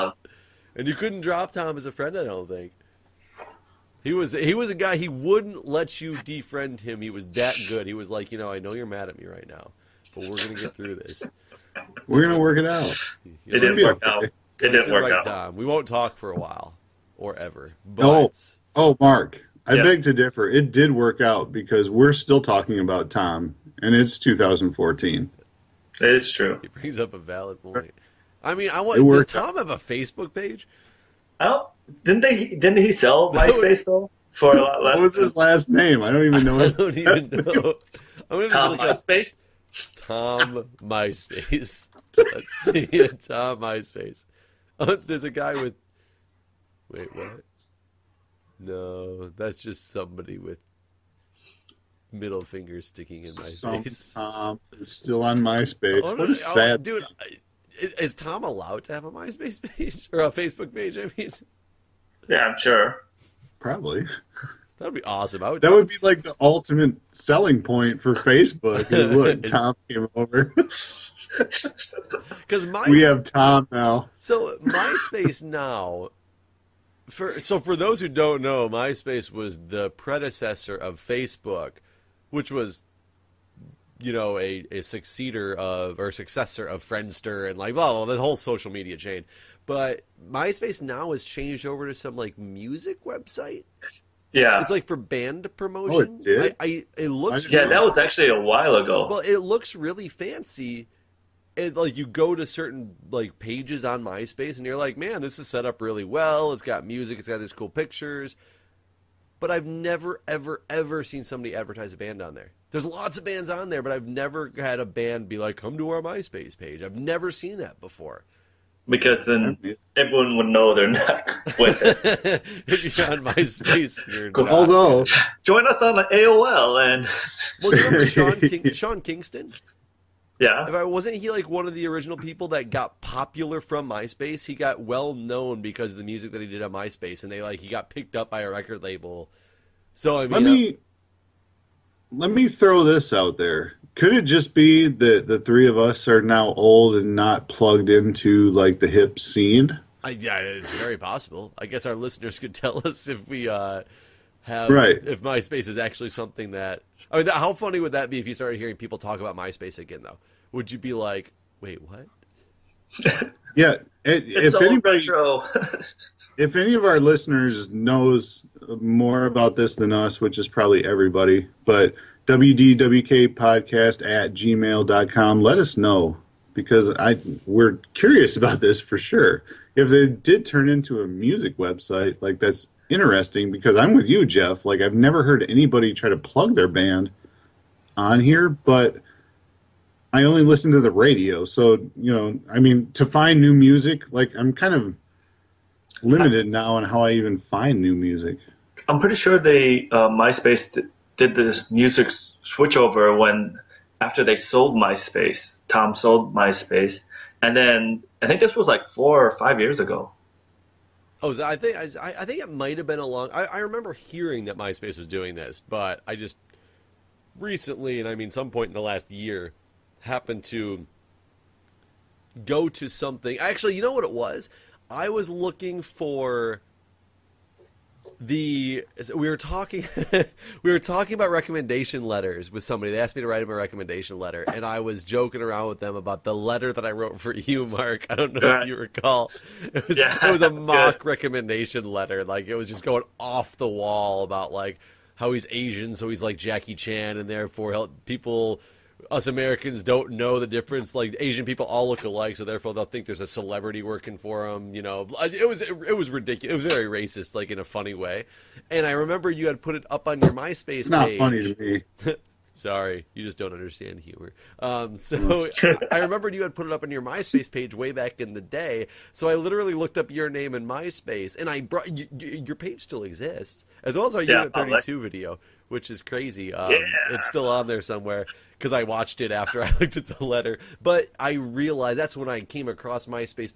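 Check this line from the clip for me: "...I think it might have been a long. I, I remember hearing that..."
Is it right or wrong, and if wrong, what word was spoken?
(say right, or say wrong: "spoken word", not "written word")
right.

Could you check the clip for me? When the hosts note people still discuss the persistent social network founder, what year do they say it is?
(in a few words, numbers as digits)
2014.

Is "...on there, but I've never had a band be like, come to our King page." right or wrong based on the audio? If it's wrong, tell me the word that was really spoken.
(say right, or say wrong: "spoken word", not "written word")
wrong: "MySpace", not "King".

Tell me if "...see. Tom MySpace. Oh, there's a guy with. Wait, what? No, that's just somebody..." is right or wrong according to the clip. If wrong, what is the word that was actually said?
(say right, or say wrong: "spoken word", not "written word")
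right.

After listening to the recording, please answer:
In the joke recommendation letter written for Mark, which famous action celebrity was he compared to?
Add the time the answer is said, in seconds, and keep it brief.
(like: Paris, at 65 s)
Jackie Chan, at 246 s.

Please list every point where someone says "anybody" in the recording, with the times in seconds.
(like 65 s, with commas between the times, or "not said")
164 s, 185 s.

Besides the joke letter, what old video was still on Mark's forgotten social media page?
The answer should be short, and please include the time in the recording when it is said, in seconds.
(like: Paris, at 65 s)
Unit 32, at 274 s.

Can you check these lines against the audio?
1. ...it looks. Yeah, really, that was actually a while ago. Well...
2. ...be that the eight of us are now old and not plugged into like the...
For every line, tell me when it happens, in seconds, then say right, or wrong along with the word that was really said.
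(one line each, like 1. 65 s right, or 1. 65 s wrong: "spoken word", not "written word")
1. 96 s right
2. 144 s wrong: "three", not "eight".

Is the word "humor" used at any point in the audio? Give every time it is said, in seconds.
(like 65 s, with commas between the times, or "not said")
264 s.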